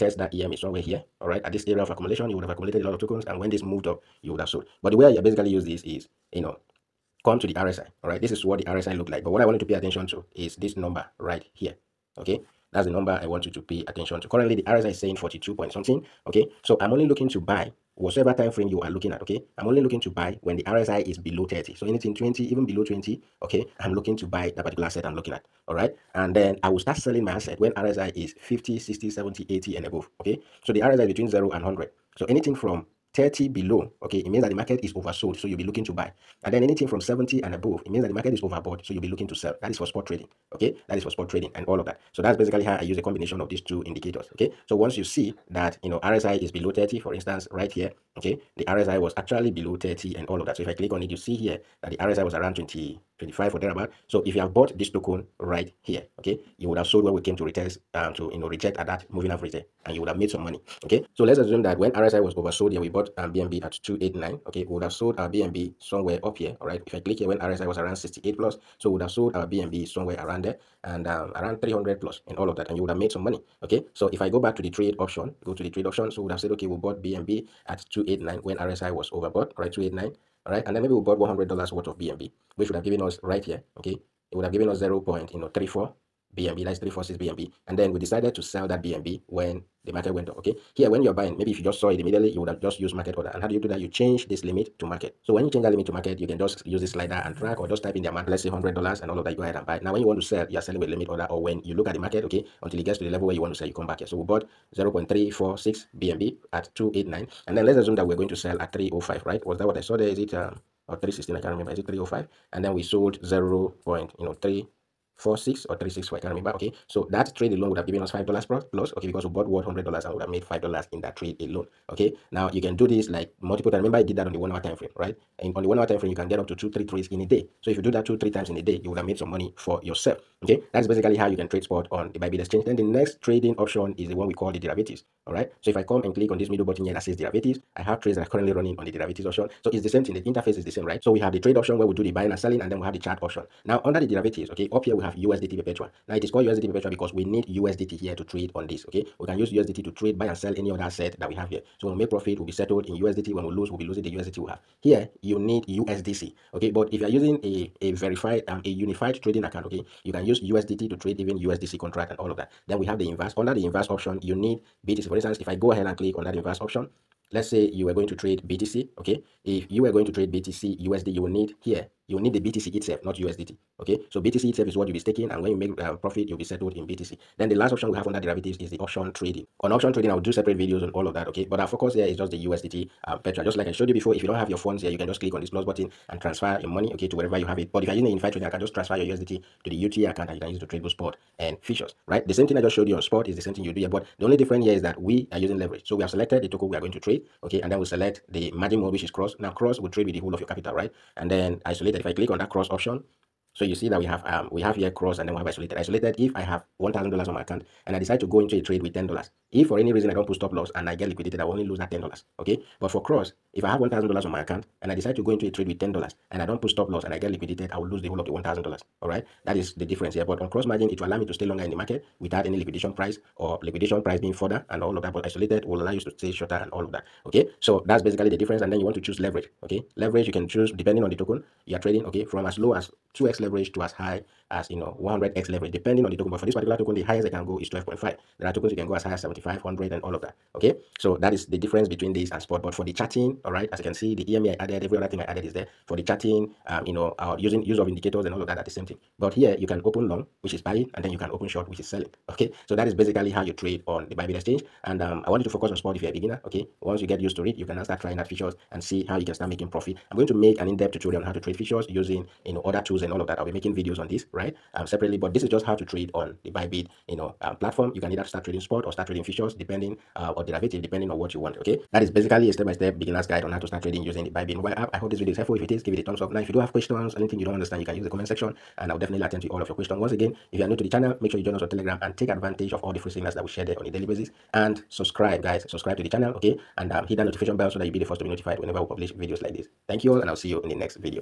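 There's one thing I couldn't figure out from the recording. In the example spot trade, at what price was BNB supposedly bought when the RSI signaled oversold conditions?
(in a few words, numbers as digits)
289.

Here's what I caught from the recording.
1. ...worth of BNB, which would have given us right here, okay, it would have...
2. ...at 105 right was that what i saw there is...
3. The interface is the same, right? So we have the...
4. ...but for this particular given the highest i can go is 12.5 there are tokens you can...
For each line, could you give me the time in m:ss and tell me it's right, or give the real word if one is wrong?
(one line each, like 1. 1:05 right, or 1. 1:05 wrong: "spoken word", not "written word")
1. 1:21 right
2. 1:48 wrong: "305", not "105"
3. 2:20 right
4. 3:56 wrong: "token", not "given".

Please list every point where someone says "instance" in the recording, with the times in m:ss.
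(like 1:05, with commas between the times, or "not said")
0:47, 2:45.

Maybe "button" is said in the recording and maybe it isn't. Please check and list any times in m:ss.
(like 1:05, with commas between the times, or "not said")
2:16, 3:05.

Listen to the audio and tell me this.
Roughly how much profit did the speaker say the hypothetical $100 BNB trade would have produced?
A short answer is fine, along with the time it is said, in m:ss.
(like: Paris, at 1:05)
5 dollars, at 1:58.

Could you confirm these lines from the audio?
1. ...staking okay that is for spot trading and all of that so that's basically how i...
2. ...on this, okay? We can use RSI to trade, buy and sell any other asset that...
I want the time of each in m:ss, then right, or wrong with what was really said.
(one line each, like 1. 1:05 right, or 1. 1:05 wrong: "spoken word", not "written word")
1. 0:40 wrong: "trading", not "staking"
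2. 2:28 wrong: "USDT", not "RSI".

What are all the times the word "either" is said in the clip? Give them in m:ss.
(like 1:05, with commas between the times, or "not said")
4:28.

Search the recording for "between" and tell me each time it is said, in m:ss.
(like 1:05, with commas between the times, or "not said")
0:31, 4:01.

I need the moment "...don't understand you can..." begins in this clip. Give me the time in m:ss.
4:37.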